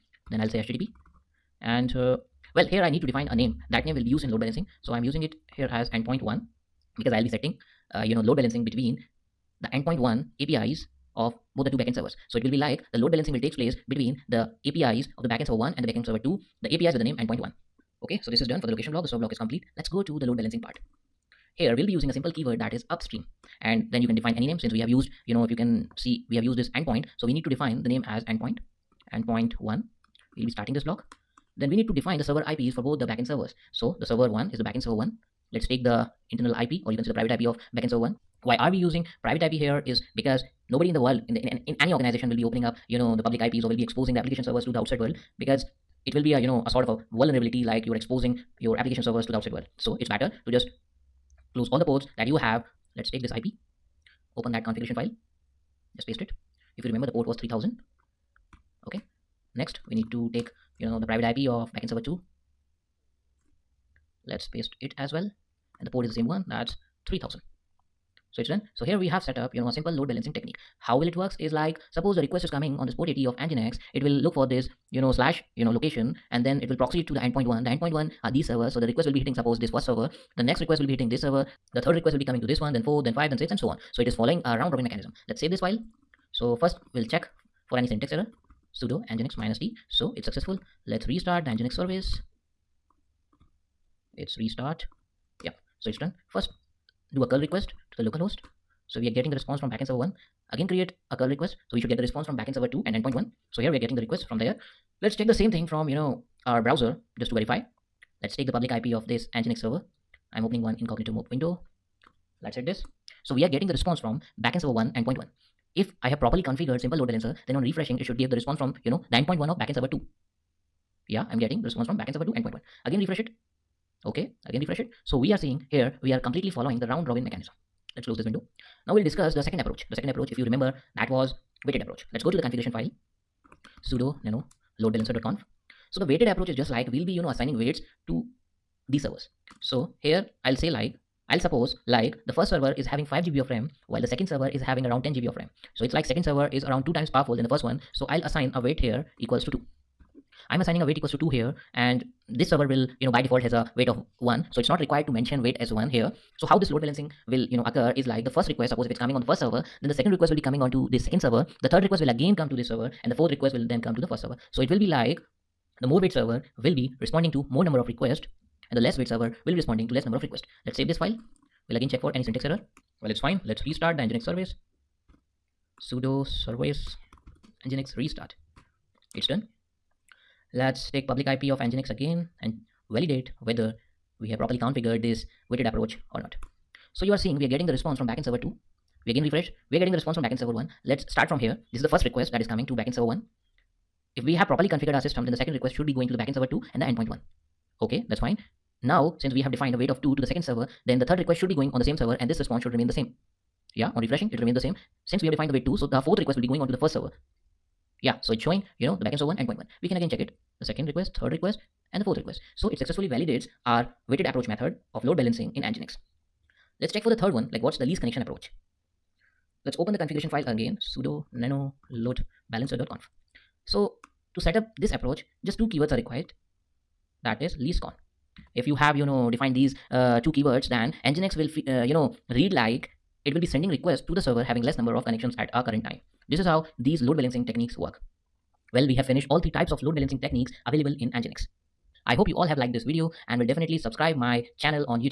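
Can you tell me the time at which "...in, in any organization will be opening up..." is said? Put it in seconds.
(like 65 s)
41 s.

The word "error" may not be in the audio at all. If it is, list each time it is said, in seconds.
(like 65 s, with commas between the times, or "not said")
88 s, 172 s.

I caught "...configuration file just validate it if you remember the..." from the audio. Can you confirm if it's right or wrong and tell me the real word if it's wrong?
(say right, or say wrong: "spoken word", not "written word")
wrong: "paste", not "validate".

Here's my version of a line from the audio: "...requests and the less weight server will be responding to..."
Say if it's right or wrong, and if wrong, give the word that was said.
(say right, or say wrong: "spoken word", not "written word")
right.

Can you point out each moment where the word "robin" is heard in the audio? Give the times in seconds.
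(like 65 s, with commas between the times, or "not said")
84 s, 127 s.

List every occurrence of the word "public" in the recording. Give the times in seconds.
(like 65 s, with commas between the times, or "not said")
43 s, 108 s, 181 s.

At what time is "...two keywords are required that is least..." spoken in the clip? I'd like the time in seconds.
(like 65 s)
225 s.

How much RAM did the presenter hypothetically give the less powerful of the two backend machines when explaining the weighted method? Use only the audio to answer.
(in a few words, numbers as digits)
5 GB.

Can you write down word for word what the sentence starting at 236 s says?
This is how these load balancing techniques work.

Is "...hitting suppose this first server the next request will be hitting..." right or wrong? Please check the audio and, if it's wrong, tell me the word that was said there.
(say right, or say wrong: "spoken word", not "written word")
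right.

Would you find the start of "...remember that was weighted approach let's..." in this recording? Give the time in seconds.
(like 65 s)
130 s.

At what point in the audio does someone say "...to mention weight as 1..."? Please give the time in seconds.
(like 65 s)
155 s.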